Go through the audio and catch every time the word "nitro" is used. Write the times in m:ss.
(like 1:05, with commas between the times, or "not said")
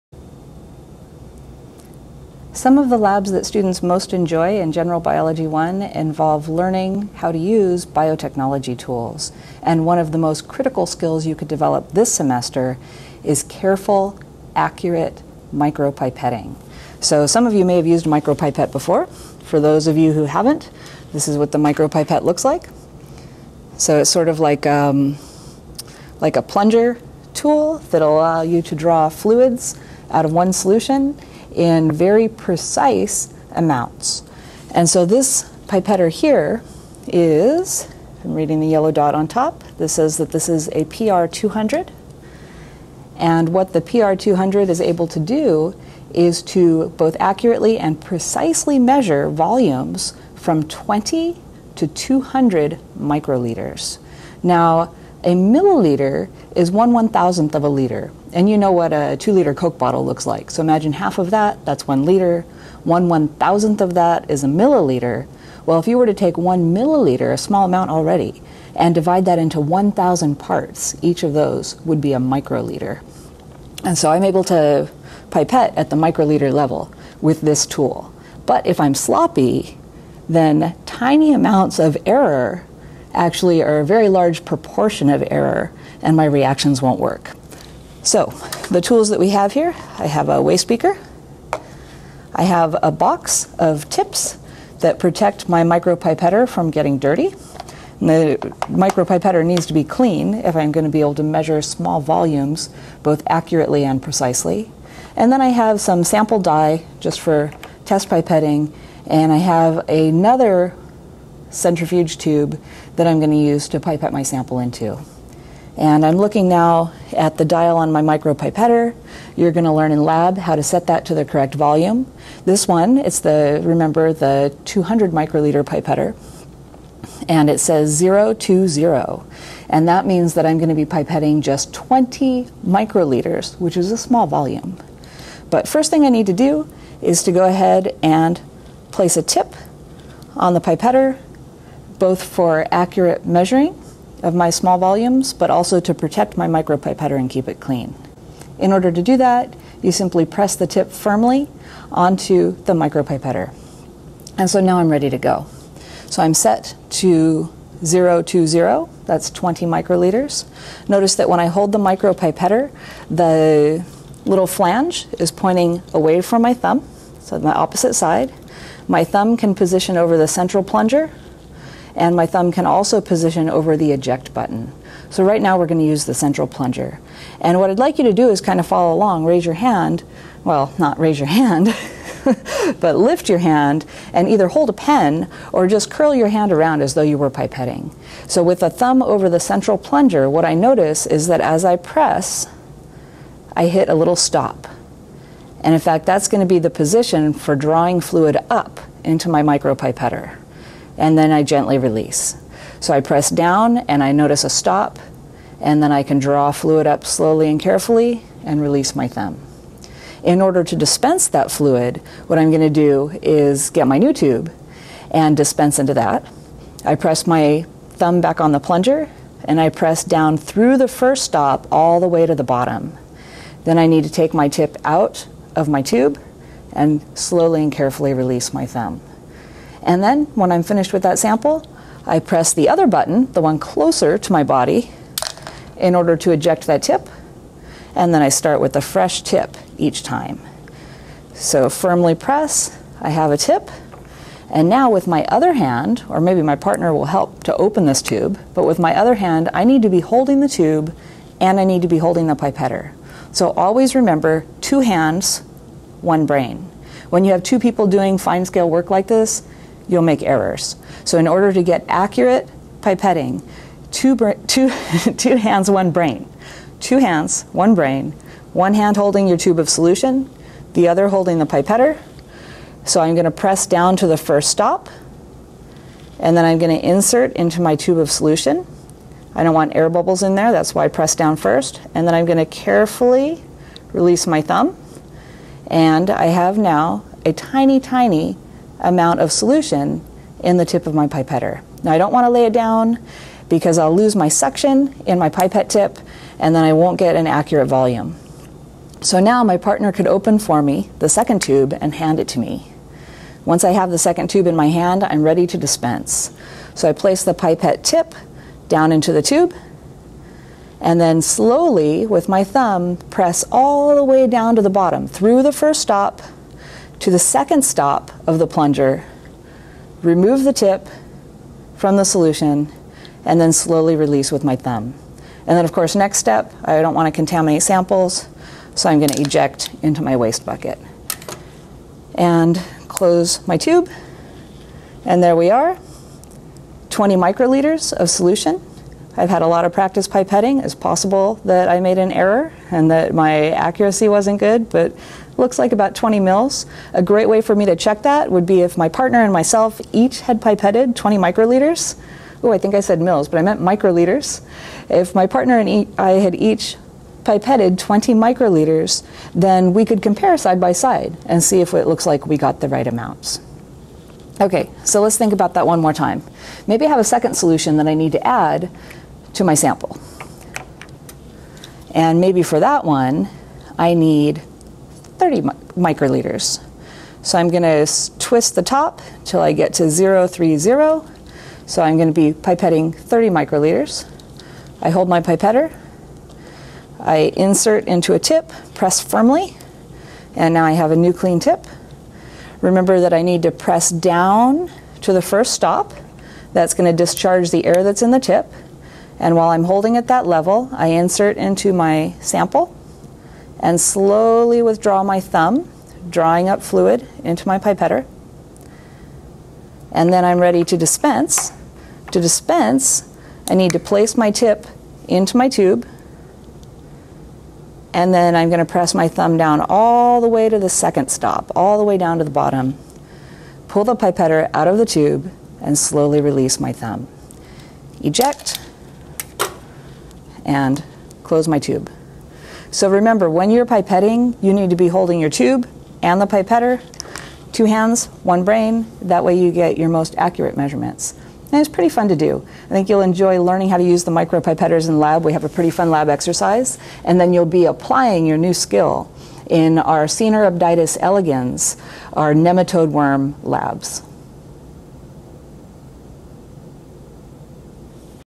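not said.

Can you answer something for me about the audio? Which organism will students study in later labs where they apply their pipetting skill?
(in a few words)
Caenorhabditis elegans.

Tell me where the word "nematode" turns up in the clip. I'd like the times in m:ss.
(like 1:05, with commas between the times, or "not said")
7:32.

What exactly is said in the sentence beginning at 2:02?
This one, it's the, remember, the 200 microliter pipetter.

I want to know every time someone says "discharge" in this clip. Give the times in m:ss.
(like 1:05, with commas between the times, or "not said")
6:36.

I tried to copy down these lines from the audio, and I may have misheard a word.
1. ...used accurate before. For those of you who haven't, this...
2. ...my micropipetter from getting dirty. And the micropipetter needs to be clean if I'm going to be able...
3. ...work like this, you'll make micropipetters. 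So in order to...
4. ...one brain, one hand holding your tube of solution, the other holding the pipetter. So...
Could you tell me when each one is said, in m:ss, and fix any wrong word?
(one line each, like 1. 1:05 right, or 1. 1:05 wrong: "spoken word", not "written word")
1. 0:17 wrong: "micropipette", not "accurate"
2. 1:35 right
3. 4:18 wrong: "errors", not "micropipetters"
4. 4:27 right.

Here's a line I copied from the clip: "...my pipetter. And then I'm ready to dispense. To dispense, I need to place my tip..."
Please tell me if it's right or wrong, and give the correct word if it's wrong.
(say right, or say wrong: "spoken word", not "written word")
right.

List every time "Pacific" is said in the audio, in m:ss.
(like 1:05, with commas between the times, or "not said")
not said.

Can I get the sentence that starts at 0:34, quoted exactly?
And so this pipetter here is, I'm reading the yellow dot on top, this says that this is a PR200.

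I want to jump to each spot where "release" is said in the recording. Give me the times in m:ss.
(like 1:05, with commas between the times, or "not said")
3:21, 3:28, 3:48, 4:43, 5:23, 7:06.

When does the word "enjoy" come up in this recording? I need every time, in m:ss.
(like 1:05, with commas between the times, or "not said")
0:04, 7:23.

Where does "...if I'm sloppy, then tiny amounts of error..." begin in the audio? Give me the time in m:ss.
1:18.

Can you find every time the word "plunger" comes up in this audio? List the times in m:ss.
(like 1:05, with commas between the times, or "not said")
0:26, 2:50, 2:56, 3:09, 3:38, 5:18.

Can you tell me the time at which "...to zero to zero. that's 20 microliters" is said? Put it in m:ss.
2:37.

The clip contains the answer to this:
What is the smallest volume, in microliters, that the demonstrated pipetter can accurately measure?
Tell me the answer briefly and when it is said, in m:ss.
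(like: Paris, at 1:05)
20 microliters, at 0:50.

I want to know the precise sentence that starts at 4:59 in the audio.
So now my partner could open for me the second tube and hand it to me.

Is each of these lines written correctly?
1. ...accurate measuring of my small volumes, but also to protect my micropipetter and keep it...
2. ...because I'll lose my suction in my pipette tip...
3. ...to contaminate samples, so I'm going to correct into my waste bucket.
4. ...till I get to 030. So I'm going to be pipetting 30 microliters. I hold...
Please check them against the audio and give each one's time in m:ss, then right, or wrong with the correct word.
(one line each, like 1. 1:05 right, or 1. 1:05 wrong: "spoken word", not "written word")
1. 2:22 right
2. 4:53 right
3. 5:27 wrong: "eject", not "correct"
4. 6:19 right.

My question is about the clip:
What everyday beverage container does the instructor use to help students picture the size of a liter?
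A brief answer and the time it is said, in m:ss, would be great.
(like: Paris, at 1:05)
two liter Coke bottle, at 0:59.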